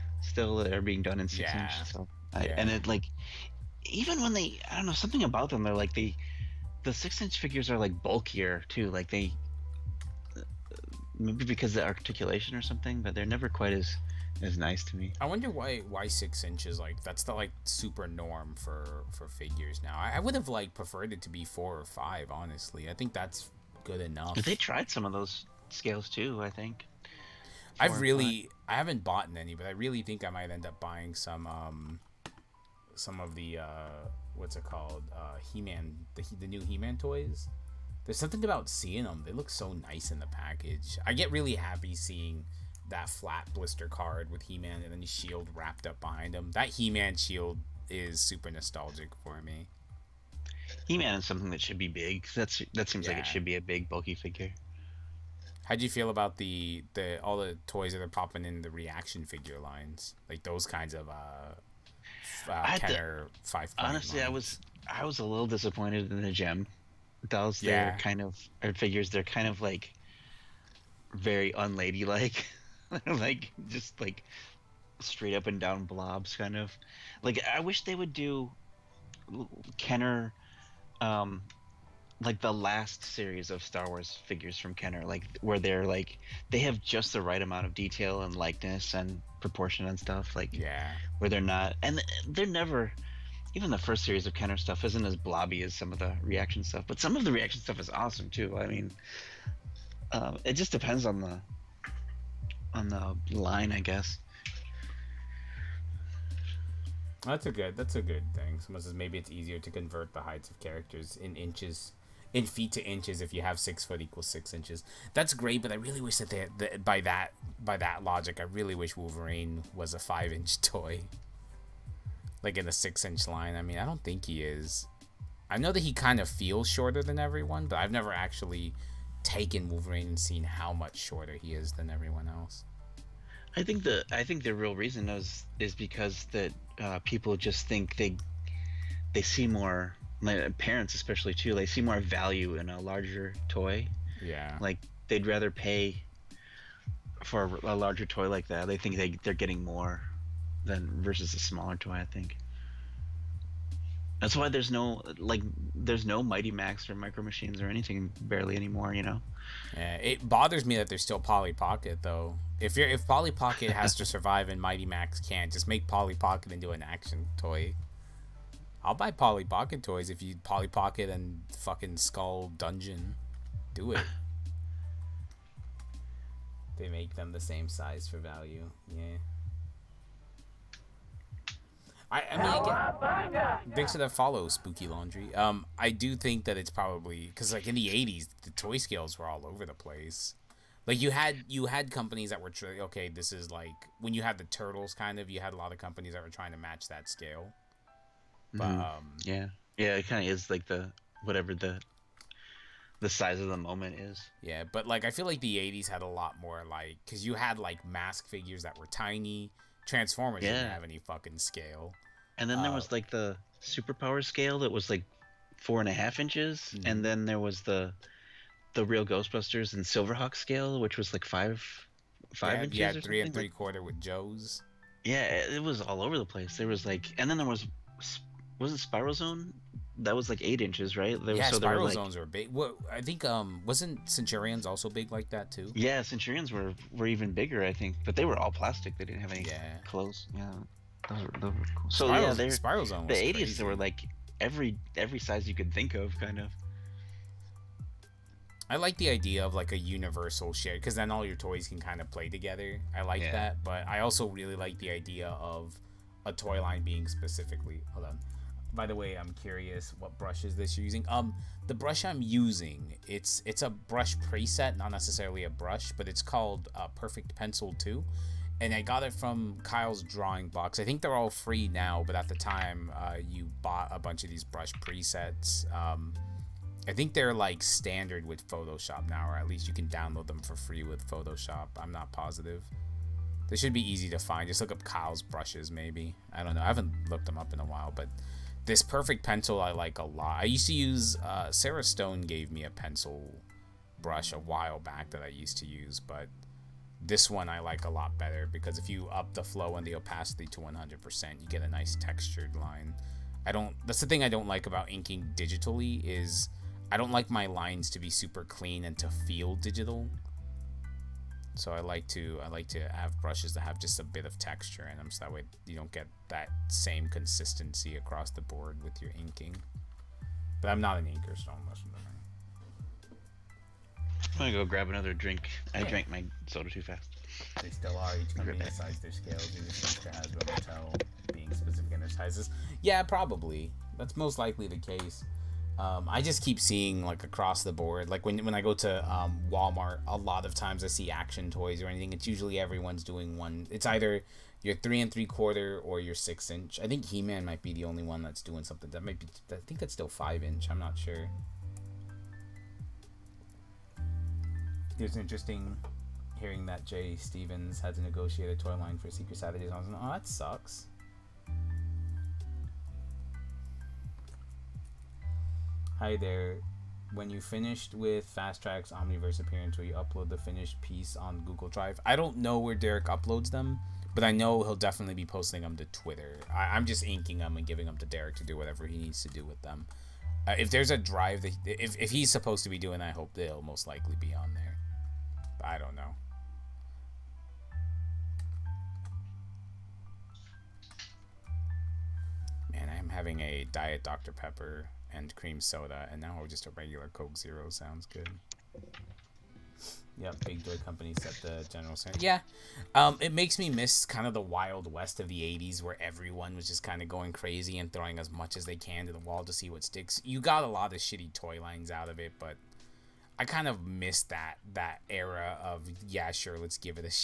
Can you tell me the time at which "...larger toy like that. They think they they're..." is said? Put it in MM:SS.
02:27.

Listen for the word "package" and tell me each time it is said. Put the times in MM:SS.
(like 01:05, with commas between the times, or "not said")
00:40.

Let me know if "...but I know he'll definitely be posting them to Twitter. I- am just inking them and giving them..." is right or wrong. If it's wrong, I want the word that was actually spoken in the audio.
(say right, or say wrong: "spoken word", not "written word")
right.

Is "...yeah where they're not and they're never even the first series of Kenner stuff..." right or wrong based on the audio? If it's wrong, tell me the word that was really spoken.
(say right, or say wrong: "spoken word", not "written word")
right.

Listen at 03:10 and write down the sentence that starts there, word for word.
Like you had you had companies that were okay.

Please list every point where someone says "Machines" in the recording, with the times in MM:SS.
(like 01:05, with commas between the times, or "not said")
02:37.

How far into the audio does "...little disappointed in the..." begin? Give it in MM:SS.
01:05.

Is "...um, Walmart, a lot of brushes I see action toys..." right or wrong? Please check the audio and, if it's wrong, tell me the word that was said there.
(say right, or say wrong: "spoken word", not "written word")
wrong: "times", not "brushes".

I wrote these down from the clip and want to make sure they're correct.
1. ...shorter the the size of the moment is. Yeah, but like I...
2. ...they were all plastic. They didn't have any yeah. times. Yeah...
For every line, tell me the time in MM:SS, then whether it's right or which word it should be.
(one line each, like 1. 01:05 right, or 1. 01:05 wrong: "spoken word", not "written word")
1. 03:21 wrong: "whatever", not "shorter"
2. 03:58 wrong: "clothes", not "times".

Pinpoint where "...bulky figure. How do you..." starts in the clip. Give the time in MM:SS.
00:53.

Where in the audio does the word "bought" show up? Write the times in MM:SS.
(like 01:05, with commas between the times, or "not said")
00:29, 04:33.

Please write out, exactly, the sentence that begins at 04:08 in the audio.
I like the idea of like a universal shared because then all your toys can kind of play together.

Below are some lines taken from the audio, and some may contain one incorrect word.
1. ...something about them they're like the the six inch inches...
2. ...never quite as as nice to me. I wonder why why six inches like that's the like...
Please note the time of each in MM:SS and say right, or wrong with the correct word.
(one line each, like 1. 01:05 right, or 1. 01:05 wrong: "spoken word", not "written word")
1. 00:04 wrong: "figures", not "inches"
2. 00:13 right.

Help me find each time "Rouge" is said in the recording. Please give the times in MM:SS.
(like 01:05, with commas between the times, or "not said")
not said.